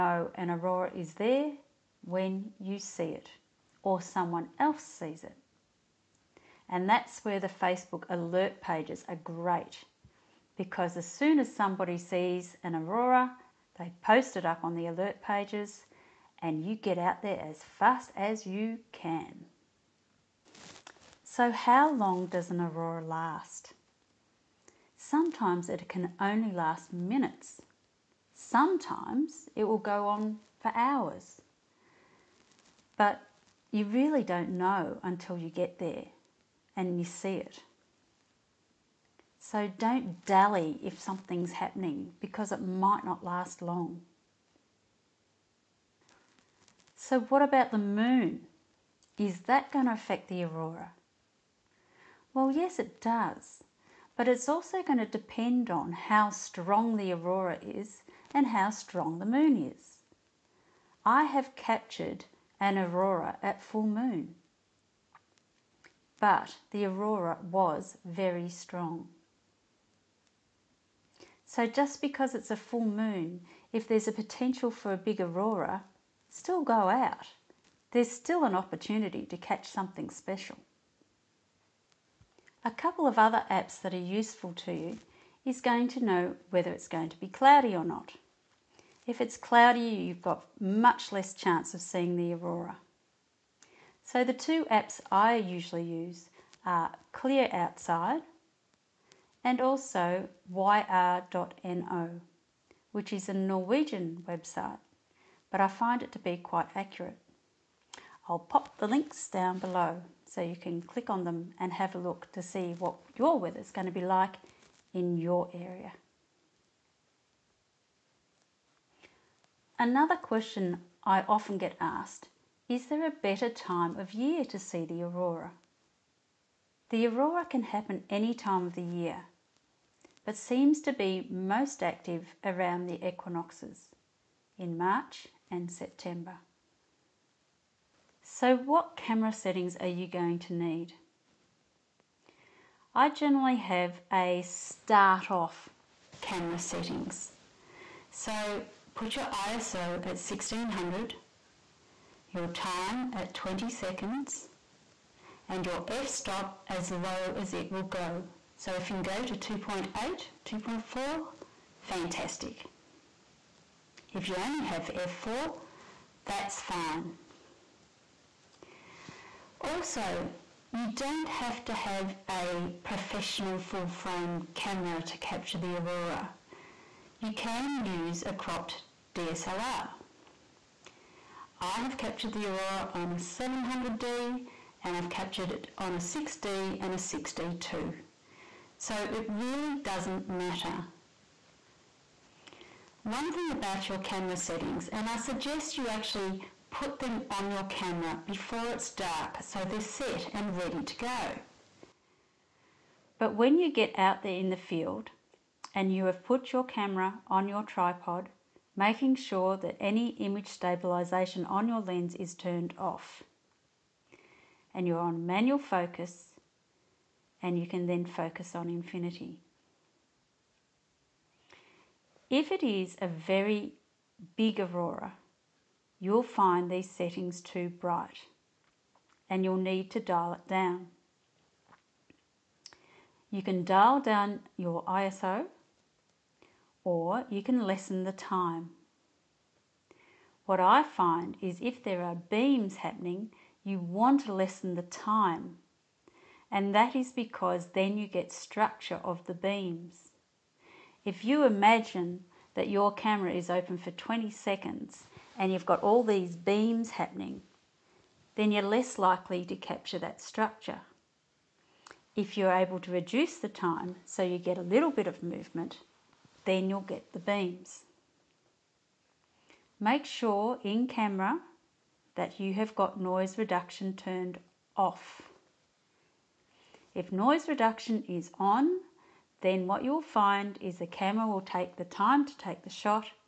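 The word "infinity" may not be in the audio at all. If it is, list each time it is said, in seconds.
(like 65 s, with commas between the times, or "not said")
218 s.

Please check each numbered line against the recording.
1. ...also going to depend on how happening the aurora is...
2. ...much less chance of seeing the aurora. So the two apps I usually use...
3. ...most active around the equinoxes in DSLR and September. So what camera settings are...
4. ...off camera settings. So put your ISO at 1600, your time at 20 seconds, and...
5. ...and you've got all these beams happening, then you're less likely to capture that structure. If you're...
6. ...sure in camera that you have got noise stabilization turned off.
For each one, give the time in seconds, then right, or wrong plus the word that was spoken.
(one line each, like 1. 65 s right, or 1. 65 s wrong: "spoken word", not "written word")
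1. 54 s wrong: "strong", not "happening"
2. 90 s right
3. 131 s wrong: "March", not "DSLR"
4. 145 s right
5. 255 s right
6. 270 s wrong: "reduction", not "stabilization".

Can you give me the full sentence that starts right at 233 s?
You can dial down your ISO or you can lessen the time.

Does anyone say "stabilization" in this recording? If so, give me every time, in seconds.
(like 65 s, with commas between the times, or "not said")
210 s.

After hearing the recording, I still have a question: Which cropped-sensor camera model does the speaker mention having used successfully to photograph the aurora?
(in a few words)
700D.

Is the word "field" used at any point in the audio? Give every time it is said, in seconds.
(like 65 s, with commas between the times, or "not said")
204 s.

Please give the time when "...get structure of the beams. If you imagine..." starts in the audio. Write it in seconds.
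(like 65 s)
248 s.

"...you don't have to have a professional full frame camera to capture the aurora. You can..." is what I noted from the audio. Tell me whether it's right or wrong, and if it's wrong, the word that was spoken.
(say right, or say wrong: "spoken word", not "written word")
right.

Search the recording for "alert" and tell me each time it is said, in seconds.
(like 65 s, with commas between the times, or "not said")
8 s, 14 s.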